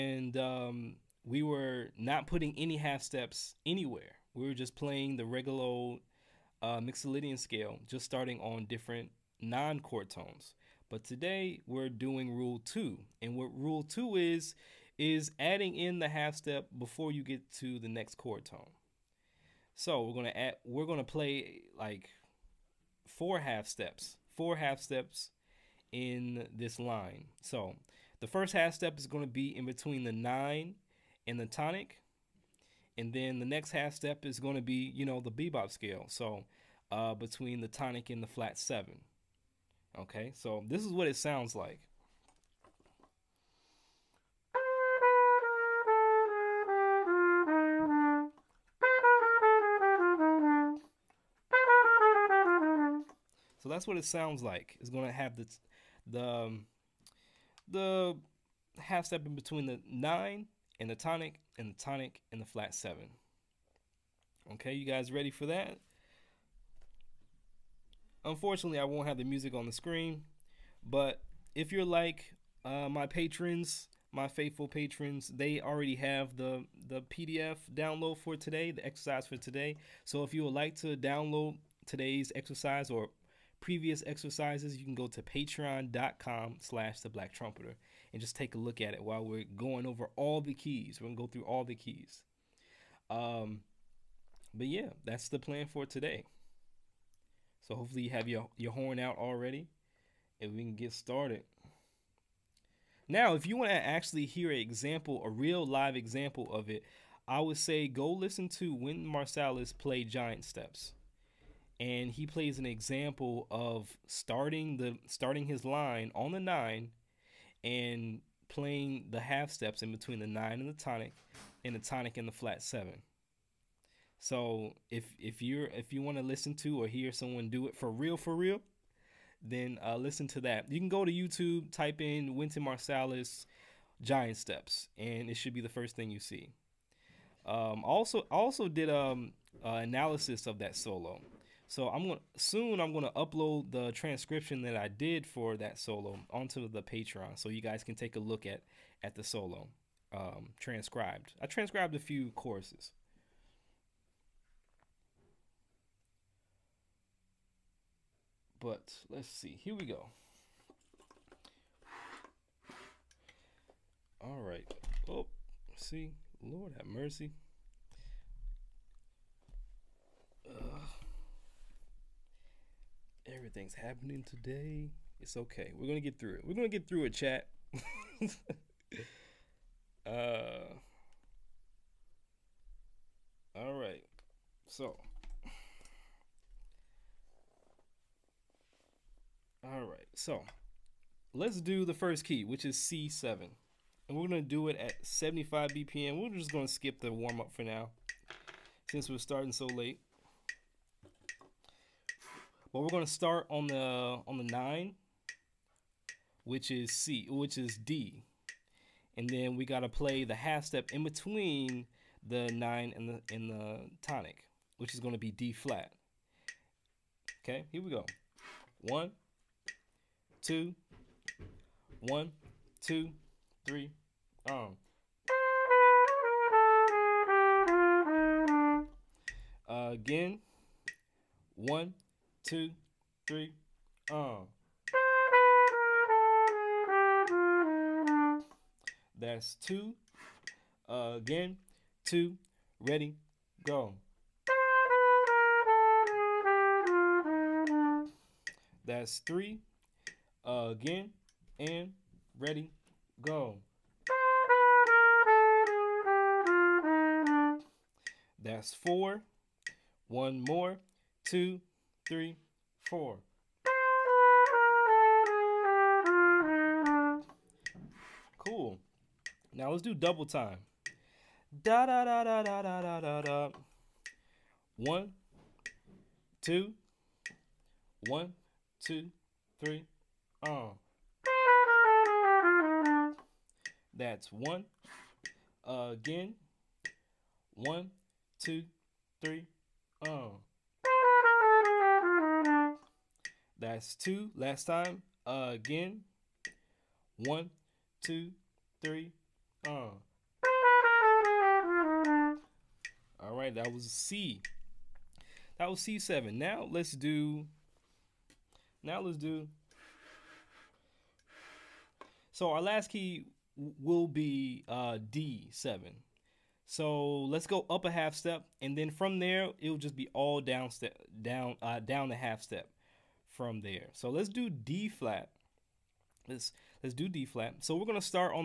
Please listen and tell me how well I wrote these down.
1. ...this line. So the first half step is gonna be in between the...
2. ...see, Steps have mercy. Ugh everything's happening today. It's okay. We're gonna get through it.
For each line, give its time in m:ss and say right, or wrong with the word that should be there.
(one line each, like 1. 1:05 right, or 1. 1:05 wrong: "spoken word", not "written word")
1. 0:26 right
2. 2:45 wrong: "Lord", not "Steps".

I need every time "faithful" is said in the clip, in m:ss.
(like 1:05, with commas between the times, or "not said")
1:14.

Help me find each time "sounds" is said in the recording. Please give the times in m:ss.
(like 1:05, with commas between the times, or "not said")
0:41, 0:54.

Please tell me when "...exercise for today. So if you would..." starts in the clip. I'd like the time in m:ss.
1:18.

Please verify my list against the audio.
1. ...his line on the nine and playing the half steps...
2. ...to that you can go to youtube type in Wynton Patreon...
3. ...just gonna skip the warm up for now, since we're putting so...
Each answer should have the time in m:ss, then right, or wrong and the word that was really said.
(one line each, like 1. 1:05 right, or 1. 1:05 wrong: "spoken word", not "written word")
1. 1:55 right
2. 2:10 wrong: "Marsalis", not "Patreon"
3. 3:16 wrong: "starting", not "putting".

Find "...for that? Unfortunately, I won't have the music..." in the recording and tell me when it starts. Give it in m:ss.
1:05.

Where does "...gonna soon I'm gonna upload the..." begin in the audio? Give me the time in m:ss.
2:22.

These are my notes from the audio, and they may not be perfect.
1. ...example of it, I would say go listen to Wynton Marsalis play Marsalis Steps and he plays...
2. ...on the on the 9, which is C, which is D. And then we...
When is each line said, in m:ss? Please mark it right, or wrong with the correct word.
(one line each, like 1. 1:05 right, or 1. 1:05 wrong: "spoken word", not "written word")
1. 1:45 wrong: "Giant", not "Marsalis"
2. 3:23 right.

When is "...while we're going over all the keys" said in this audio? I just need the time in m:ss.
1:29.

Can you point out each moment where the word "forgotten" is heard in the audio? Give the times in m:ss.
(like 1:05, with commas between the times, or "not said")
not said.